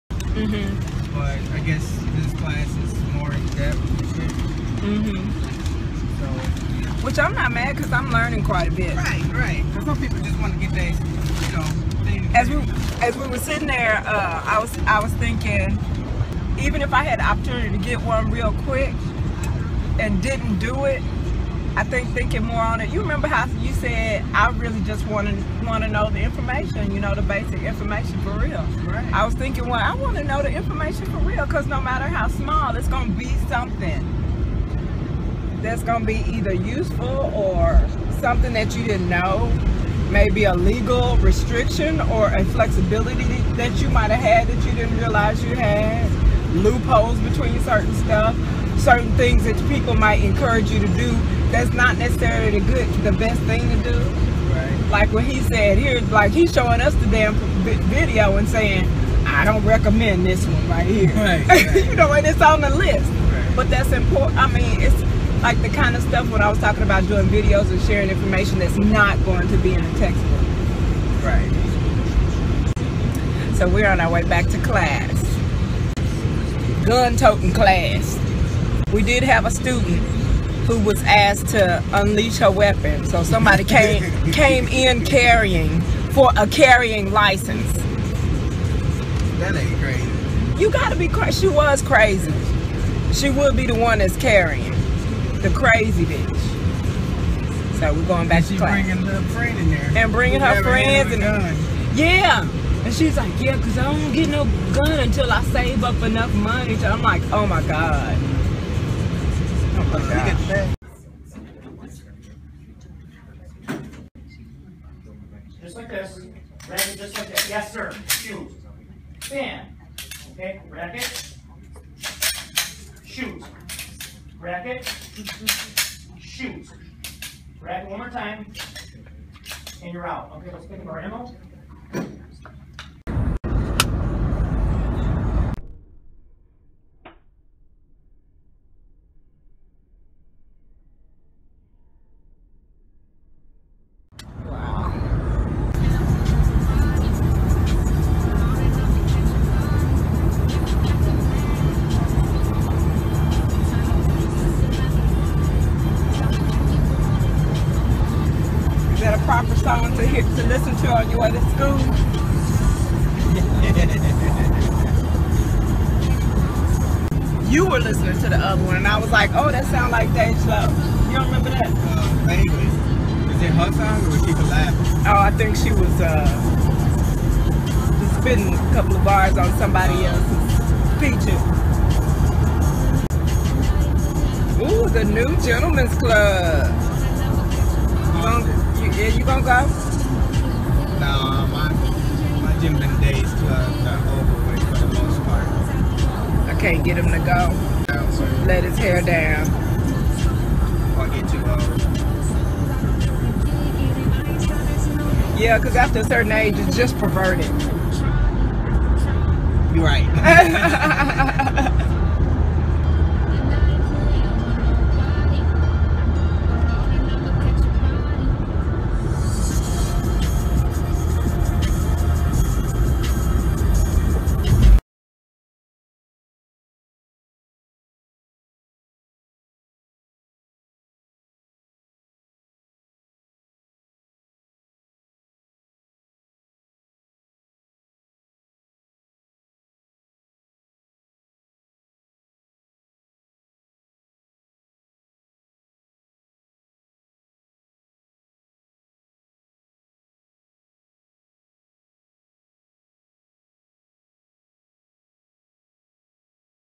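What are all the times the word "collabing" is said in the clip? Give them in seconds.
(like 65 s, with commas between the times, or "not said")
174 s.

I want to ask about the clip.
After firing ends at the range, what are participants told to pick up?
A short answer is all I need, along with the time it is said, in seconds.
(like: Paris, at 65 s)
ammo, at 131 s.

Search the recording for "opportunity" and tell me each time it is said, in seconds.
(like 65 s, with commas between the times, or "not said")
17 s.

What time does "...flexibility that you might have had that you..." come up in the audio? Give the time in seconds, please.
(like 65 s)
42 s.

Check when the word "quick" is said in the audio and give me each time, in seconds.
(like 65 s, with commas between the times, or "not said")
18 s.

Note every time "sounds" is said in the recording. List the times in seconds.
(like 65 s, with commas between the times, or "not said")
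169 s.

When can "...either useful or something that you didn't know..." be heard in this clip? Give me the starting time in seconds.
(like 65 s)
36 s.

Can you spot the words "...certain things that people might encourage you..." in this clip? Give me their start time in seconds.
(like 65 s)
48 s.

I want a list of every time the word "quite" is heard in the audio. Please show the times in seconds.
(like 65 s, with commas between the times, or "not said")
8 s.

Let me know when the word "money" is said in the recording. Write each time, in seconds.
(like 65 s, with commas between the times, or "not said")
106 s.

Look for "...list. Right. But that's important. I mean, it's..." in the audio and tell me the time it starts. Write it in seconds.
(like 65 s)
62 s.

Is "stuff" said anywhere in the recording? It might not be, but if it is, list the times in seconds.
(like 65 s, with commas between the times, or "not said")
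47 s, 66 s.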